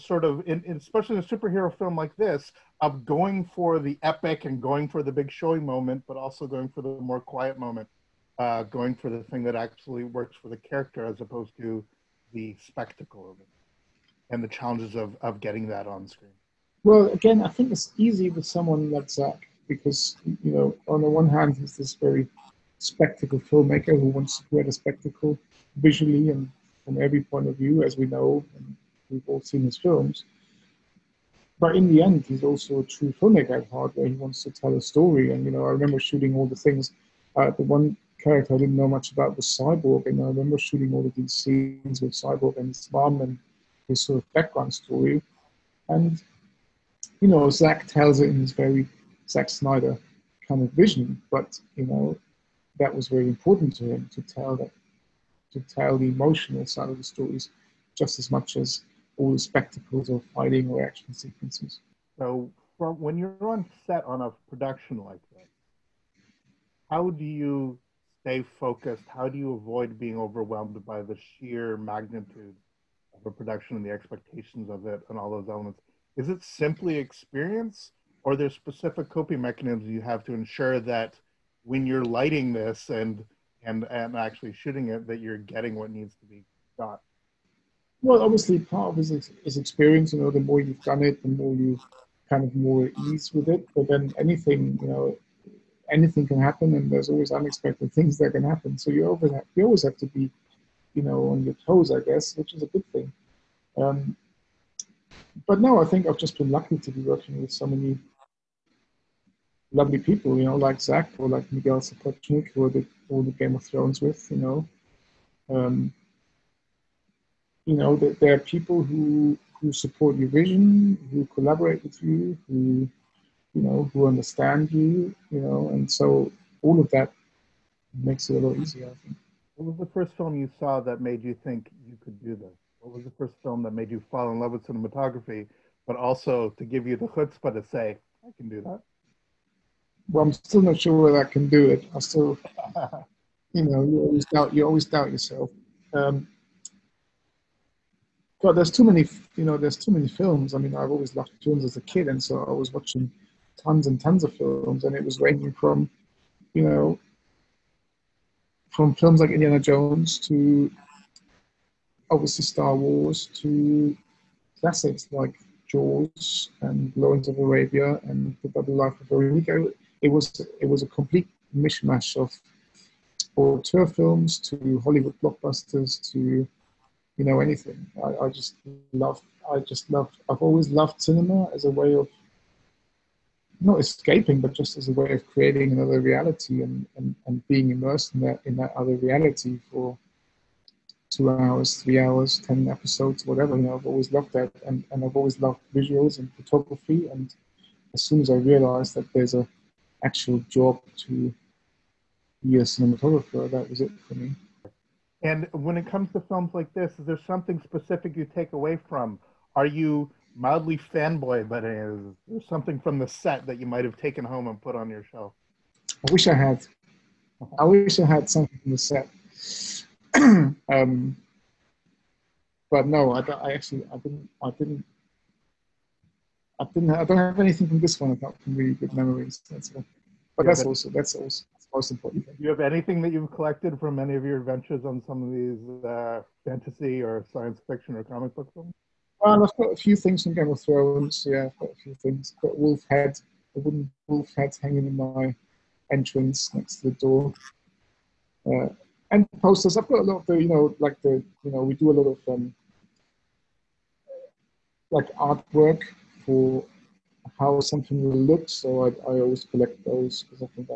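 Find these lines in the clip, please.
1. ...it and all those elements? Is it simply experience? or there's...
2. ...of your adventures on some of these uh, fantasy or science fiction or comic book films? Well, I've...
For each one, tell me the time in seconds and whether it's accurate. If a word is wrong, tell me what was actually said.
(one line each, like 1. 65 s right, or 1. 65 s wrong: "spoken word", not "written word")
1. 74 s right
2. 234 s right.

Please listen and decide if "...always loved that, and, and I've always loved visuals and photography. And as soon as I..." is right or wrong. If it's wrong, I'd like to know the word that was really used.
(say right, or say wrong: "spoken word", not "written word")
right.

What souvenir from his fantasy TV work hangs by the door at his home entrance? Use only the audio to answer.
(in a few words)
A wooden wolf head.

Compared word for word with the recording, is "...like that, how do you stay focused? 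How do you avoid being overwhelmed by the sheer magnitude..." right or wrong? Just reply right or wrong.
right.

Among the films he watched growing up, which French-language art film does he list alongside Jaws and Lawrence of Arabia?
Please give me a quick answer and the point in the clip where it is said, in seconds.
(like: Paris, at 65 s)
The Life of Veronique, at 168 s.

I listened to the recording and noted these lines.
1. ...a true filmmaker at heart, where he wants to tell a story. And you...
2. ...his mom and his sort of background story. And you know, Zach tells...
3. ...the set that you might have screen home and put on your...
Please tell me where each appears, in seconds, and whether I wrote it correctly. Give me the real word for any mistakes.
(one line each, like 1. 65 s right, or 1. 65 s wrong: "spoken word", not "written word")
1. 32 s right
2. 42 s right
3. 212 s wrong: "taken", not "screen".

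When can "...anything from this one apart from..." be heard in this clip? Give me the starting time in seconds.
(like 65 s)
227 s.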